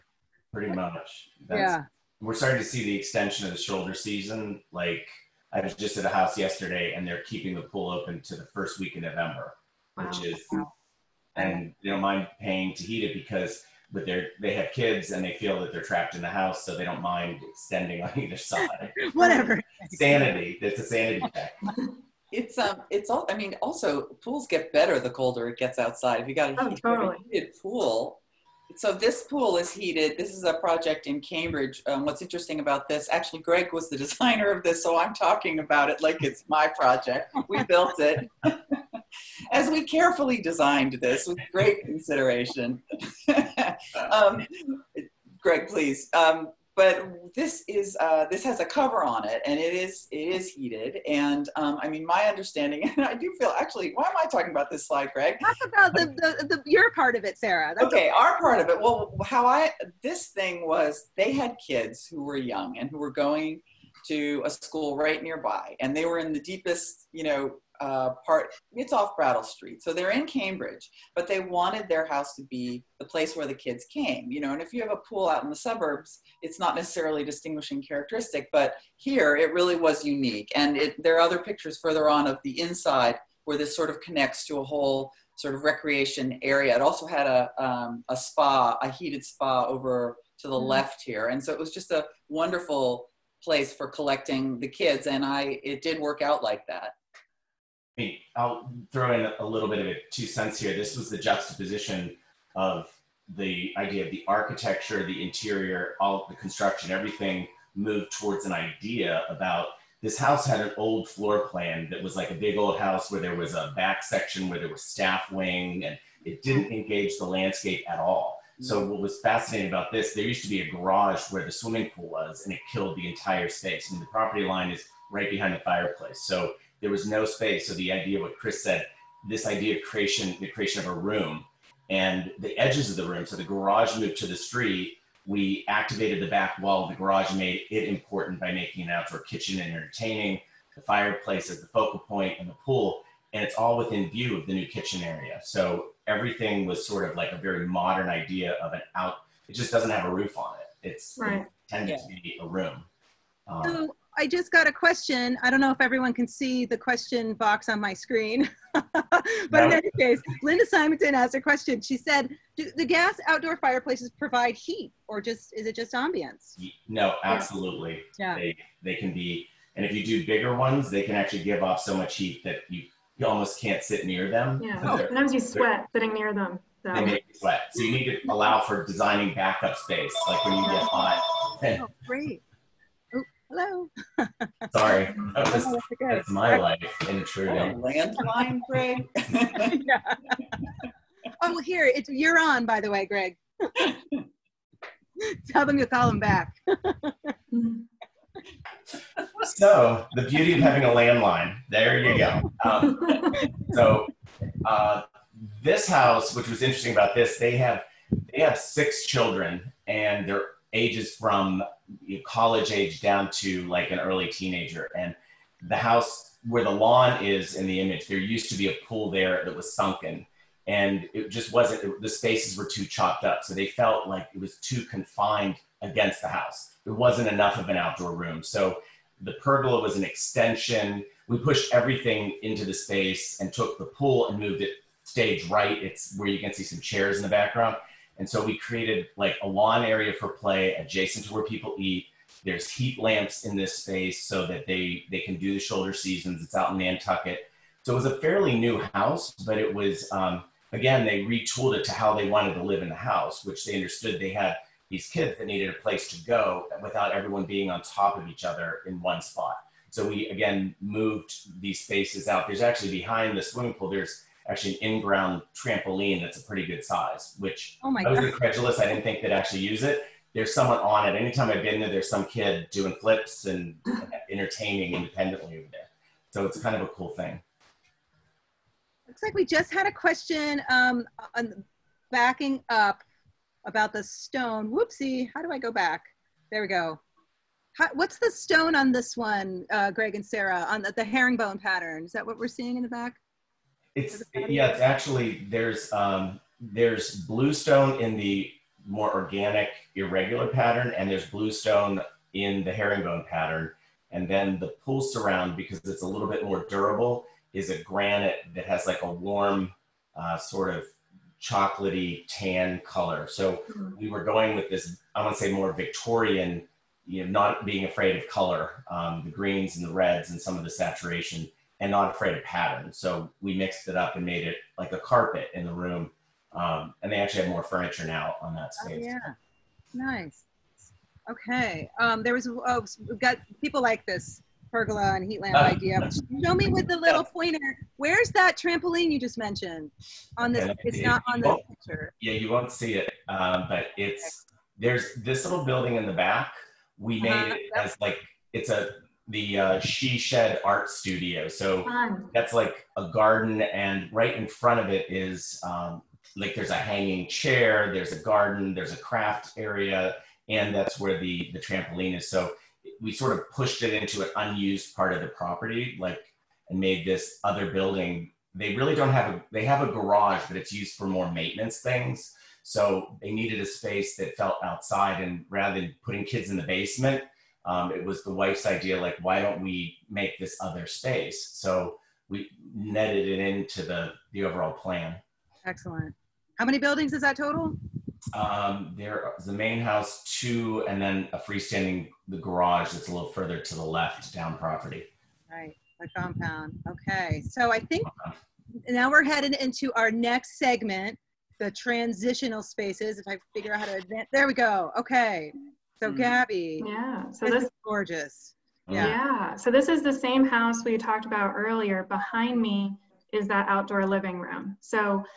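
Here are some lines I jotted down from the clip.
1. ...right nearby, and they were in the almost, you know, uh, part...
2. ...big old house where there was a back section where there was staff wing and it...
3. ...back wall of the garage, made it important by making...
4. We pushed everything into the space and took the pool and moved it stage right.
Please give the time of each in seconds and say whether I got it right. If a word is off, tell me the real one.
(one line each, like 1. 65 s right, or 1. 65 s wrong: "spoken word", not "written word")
1. 64 s wrong: "deepest", not "almost"
2. 112 s right
3. 136 s right
4. 231 s right.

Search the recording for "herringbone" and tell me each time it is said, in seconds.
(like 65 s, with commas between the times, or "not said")
291 s, 302 s.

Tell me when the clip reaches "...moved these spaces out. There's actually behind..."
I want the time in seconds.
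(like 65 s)
260 s.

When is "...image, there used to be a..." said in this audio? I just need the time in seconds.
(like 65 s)
217 s.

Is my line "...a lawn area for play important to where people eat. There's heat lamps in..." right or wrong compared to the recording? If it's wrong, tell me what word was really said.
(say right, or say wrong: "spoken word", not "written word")
wrong: "adjacent", not "important".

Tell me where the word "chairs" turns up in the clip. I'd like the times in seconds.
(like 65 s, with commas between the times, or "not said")
236 s, 357 s.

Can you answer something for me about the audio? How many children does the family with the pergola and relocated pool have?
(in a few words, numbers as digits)
6.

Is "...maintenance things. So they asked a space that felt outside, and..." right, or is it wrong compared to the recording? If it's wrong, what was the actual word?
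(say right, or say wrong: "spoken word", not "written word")
wrong: "needed", not "asked".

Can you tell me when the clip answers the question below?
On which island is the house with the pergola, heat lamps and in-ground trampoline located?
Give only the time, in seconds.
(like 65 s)
246 s.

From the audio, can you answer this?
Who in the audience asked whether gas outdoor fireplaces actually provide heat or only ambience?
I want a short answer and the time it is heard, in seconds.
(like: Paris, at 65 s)
Linda Simonton, at 160 s.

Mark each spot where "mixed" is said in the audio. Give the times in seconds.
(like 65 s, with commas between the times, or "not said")
323 s.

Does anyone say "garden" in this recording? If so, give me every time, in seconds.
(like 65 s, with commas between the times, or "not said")
353 s, 358 s.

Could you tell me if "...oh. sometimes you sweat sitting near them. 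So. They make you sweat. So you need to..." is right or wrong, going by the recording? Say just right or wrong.
right.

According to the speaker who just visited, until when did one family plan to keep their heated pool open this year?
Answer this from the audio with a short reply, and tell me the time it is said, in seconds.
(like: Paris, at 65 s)
First week in November, at 8 s.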